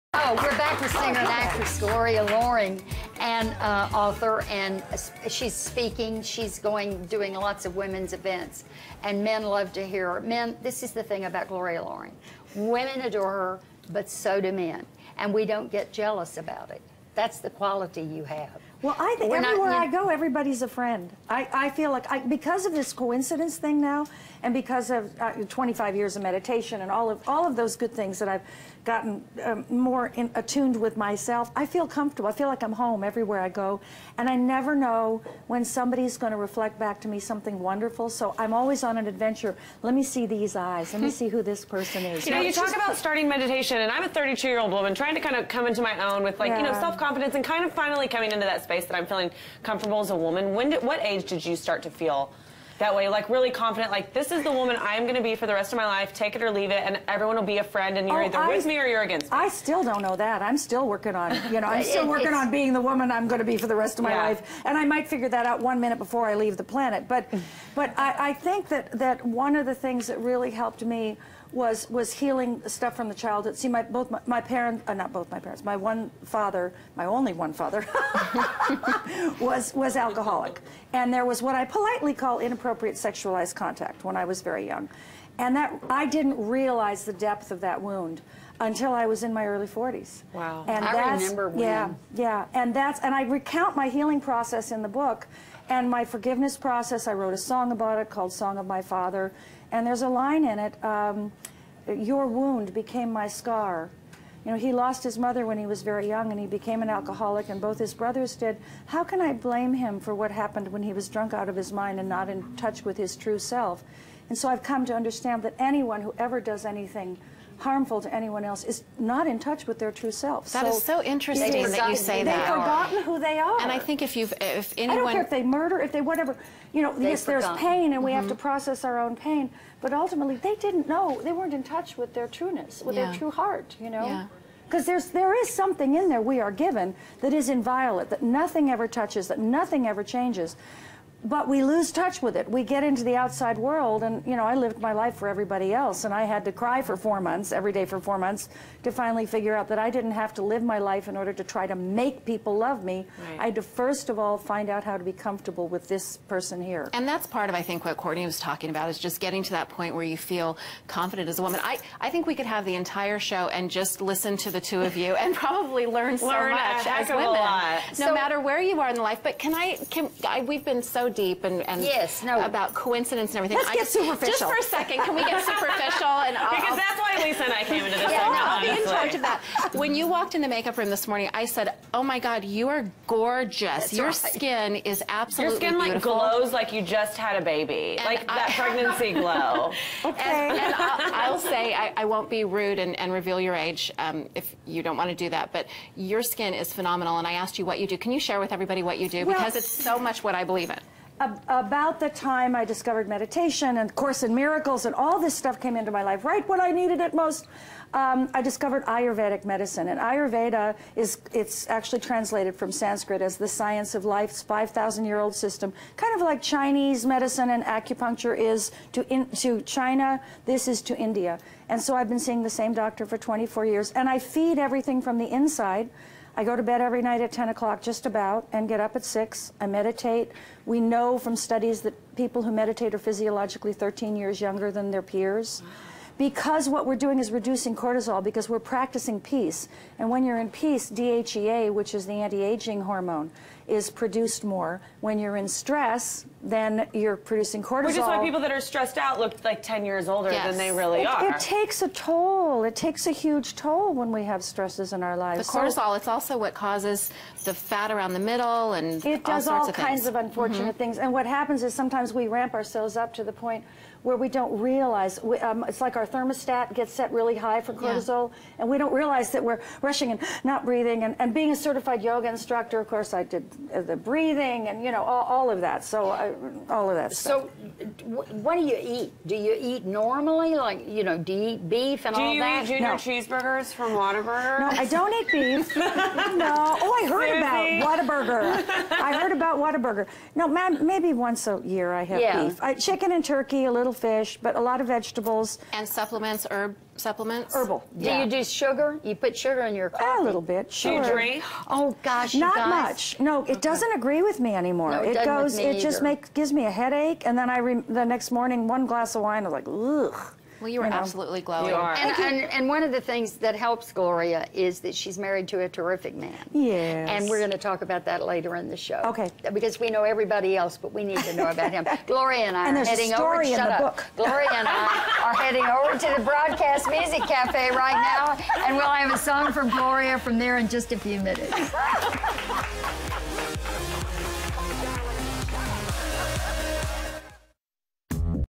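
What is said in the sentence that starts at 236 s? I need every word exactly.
Because what we're doing is reducing cortisol, because we're practicing peace.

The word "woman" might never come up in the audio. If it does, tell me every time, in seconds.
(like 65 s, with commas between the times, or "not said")
44 s, 50 s, 54 s, 62 s, 161 s.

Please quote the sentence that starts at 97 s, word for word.
I wrote a song about it called Song of My Father.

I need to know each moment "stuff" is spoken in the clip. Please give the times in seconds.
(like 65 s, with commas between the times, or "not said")
72 s, 205 s, 277 s.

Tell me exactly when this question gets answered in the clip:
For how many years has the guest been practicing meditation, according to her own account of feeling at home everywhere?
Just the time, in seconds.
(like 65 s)
25 s.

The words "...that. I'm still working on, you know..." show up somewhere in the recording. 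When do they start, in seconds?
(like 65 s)
60 s.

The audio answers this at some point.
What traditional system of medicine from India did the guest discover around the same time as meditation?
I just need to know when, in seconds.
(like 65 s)
208 s.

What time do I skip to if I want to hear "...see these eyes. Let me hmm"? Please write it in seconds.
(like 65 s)
40 s.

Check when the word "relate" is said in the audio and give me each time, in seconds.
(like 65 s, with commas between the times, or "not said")
not said.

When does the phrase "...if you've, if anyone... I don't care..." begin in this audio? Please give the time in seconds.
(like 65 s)
124 s.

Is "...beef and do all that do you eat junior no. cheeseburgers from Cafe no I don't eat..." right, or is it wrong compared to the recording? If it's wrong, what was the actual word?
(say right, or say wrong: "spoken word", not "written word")
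wrong: "Whataburger", not "Cafe".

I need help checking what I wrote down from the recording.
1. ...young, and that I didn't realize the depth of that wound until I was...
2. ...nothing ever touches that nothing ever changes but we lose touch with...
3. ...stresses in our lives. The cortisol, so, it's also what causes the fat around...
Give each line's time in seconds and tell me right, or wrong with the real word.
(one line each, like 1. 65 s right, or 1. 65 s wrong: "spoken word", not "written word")
1. 84 s right
2. 138 s right
3. 254 s right.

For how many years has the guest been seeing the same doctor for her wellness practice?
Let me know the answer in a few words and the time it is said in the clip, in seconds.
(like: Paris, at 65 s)
24, at 223 s.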